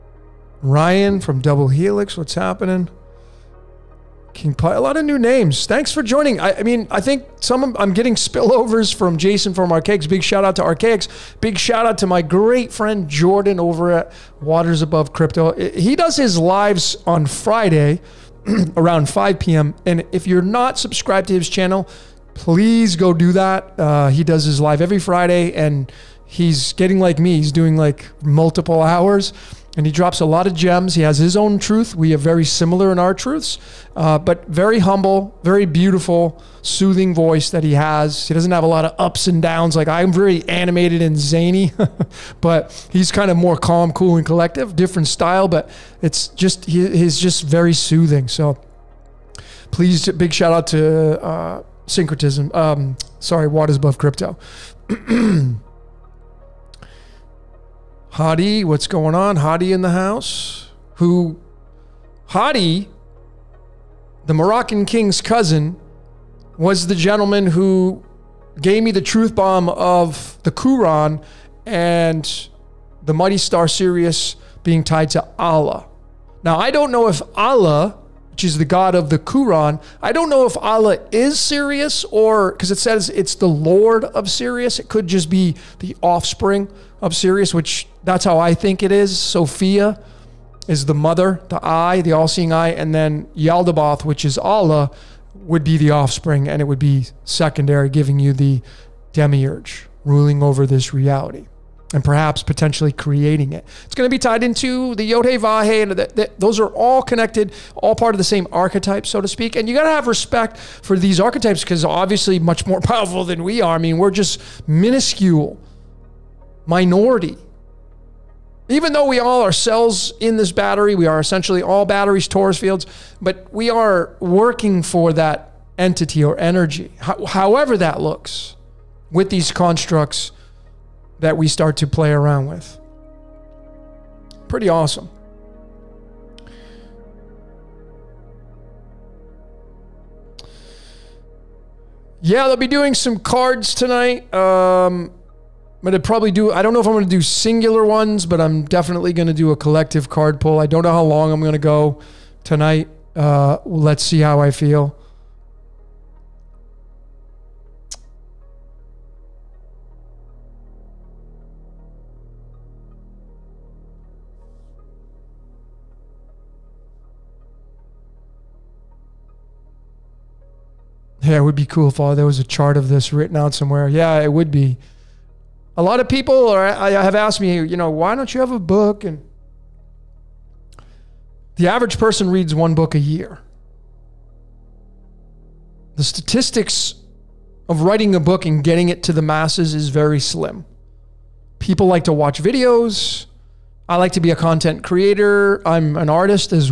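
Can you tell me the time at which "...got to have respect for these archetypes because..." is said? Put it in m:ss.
1:49.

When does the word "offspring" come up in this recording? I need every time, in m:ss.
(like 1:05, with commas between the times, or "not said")
1:26, 1:35.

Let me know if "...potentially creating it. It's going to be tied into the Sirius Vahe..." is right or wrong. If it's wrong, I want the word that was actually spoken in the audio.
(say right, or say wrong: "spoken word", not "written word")
wrong: "Yodhe", not "Sirius".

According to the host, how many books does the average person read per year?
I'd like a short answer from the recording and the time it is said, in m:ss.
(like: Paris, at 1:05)
1, at 3:02.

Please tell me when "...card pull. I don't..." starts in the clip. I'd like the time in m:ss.
2:30.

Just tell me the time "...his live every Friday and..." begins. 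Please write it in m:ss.
0:24.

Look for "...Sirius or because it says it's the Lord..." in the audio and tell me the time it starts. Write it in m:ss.
1:21.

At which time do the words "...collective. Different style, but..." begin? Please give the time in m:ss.
0:44.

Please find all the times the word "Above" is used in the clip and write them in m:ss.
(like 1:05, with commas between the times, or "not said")
0:14, 0:53.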